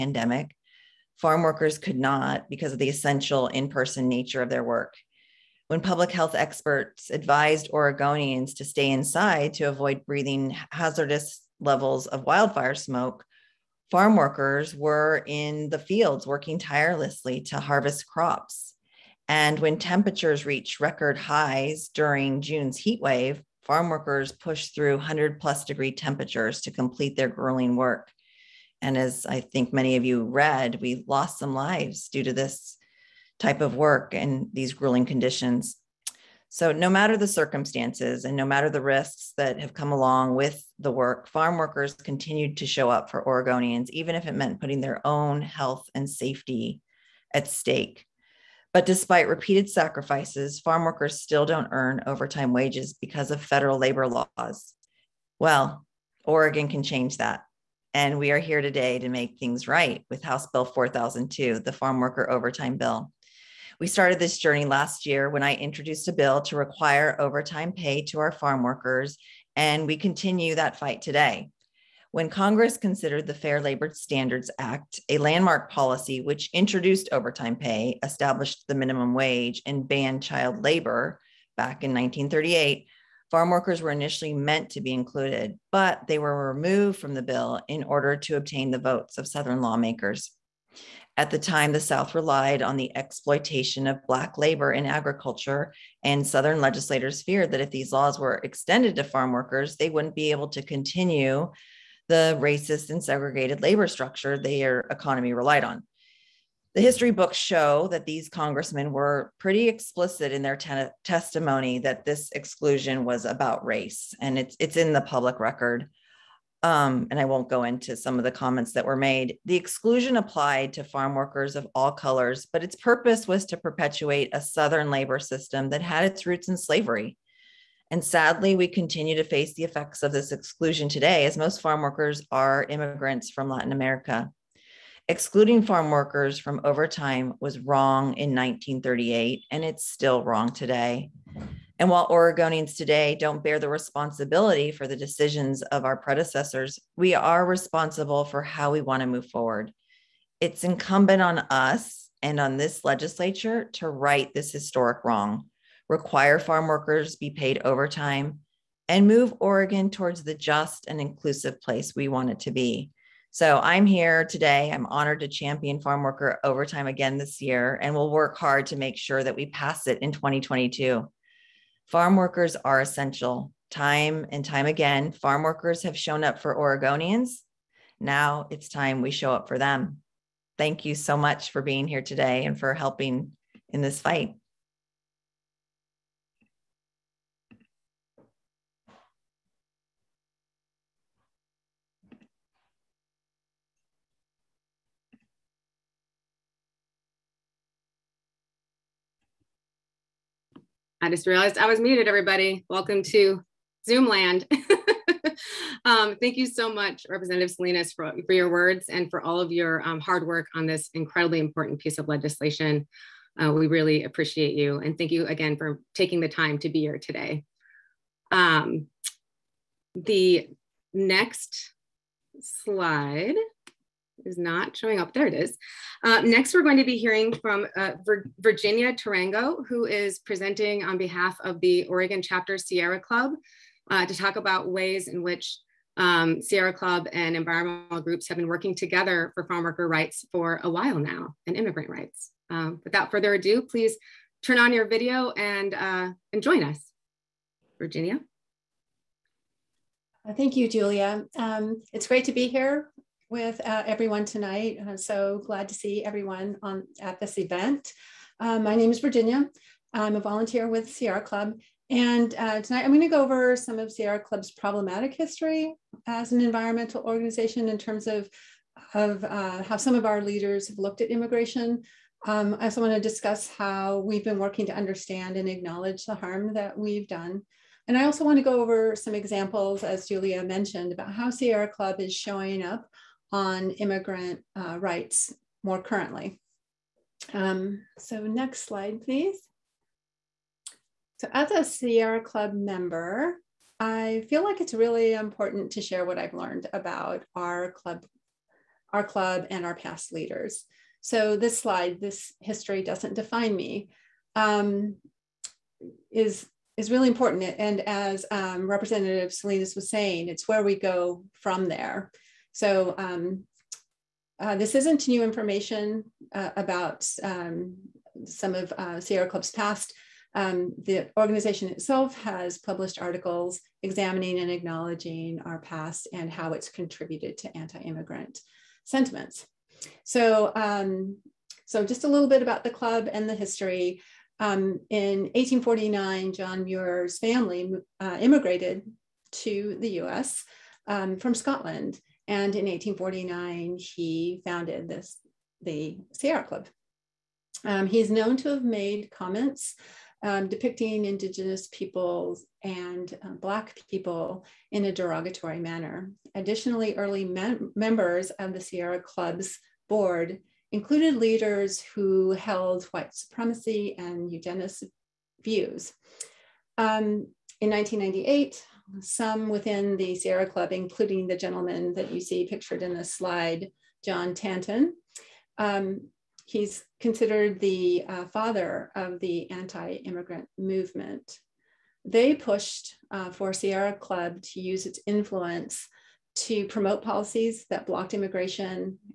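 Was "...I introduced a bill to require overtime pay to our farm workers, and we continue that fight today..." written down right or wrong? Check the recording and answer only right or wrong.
right.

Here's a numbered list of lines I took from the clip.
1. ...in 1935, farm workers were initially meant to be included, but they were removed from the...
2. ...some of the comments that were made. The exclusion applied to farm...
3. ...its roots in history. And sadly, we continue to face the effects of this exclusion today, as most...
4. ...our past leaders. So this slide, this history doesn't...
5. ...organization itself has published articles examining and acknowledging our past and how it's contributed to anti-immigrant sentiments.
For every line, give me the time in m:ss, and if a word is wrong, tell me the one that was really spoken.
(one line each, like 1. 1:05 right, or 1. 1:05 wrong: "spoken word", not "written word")
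1. 1:21 wrong: "1938", not "1935"
2. 1:57 right
3. 2:06 wrong: "slavery", not "history"
4. 4:59 right
5. 5:21 right.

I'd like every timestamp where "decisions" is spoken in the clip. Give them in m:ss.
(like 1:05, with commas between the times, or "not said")
2:24.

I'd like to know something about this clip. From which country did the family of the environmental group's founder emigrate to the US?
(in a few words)
Scotland.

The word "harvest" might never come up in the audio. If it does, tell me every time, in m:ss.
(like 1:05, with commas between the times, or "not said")
0:17.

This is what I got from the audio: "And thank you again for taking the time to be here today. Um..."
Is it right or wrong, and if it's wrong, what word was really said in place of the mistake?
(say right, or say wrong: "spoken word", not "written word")
right.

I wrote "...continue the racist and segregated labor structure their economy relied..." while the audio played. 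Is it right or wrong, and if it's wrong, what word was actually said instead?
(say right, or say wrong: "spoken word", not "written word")
right.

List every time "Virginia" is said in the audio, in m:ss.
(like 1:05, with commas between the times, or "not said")
3:48, 4:07, 4:19.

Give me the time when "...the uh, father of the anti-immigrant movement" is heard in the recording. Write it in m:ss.
6:17.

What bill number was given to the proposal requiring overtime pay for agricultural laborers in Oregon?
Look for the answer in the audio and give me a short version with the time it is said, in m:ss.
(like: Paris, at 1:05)
House Bill 4002, at 1:00.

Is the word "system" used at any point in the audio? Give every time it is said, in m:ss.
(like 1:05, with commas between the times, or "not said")
2:05.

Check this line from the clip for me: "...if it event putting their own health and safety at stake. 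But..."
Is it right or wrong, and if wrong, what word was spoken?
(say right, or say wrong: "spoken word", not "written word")
wrong: "meant", not "event".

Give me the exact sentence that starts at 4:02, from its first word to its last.
Um, without further ado, please turn on your video and, uh, and join us.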